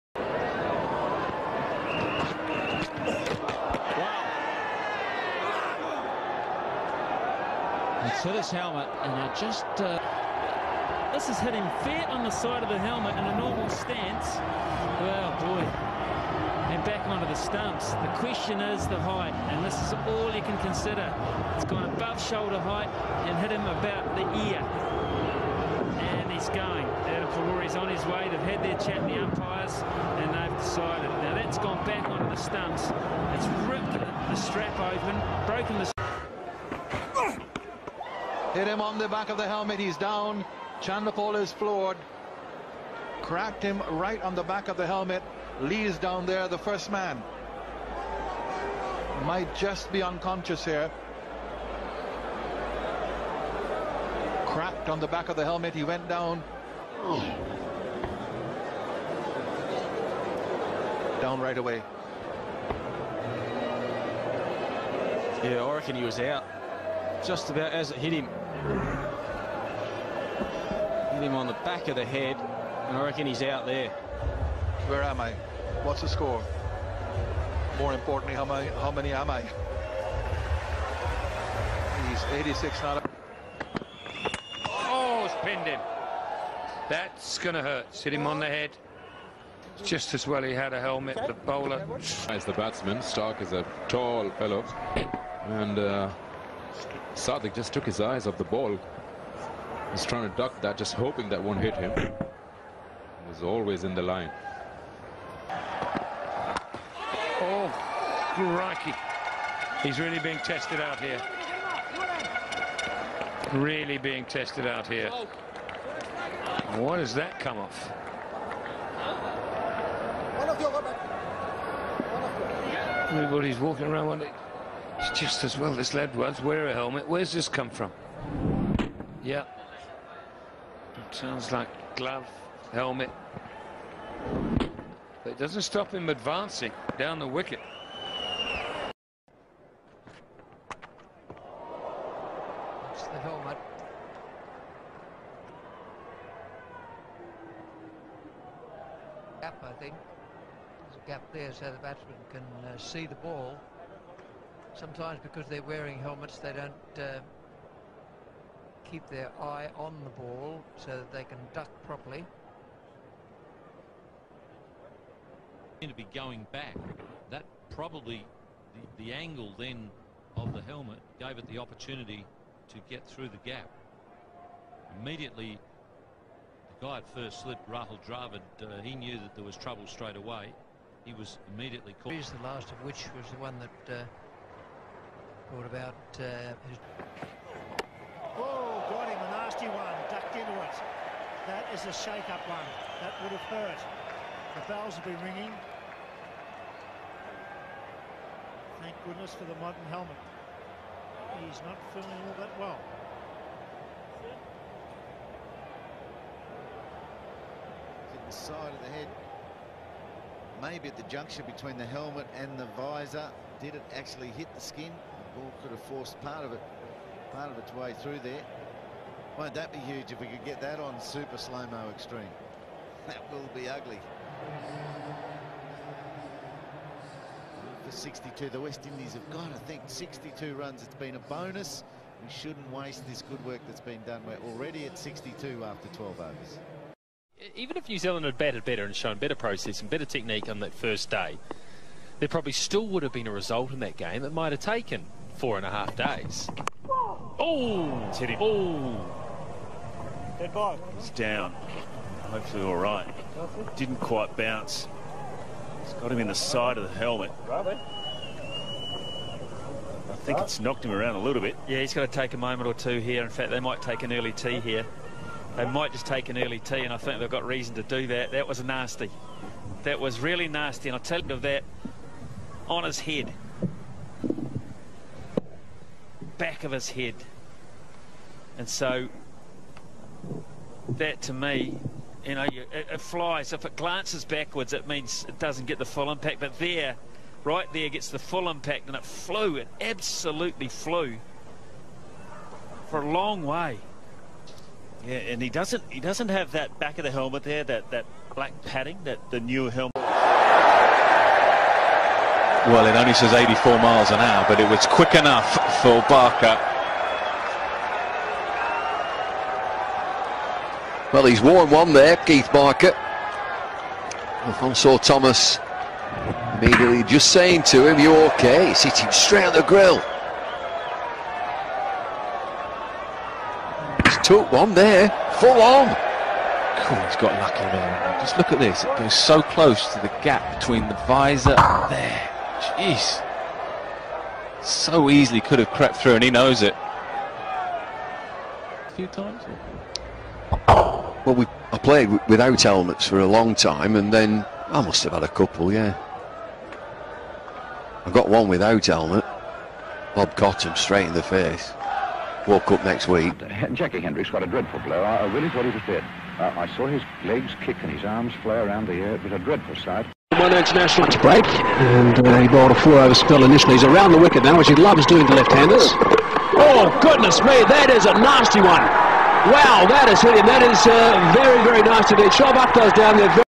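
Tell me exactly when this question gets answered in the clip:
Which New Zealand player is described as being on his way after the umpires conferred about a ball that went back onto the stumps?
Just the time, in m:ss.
0:27.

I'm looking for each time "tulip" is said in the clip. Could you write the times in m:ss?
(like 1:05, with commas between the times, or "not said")
not said.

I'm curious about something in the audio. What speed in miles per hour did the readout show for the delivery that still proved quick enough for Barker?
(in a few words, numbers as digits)
84.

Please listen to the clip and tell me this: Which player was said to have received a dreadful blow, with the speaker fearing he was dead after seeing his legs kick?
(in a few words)
Jackie Hendriks.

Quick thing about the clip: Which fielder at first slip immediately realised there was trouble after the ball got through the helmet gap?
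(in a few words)
Rahul Dravid.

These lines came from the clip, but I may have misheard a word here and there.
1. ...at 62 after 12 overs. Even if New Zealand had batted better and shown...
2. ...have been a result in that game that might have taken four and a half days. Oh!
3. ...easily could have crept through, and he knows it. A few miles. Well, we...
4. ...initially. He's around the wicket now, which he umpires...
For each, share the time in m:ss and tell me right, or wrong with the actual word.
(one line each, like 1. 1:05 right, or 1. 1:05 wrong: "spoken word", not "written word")
1. 3:54 right
2. 4:03 right
3. 5:35 wrong: "times", not "miles"
4. 6:03 wrong: "loves", not "umpires".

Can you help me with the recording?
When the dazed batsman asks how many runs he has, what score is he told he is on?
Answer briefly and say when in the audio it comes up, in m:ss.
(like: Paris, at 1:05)
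86, at 1:22.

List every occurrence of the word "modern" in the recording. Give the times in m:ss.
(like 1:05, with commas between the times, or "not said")
3:19.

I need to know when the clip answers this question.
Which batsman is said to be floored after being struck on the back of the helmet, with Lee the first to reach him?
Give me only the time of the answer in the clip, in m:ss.
0:40.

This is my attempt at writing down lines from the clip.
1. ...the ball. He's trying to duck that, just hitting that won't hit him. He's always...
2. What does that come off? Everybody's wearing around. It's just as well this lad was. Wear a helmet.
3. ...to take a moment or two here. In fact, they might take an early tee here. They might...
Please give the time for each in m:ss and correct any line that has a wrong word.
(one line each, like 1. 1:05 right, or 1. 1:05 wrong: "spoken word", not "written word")
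1. 1:38 wrong: "hoping", not "hitting"
2. 1:56 wrong: "walking", not "wearing"
3. 4:22 right.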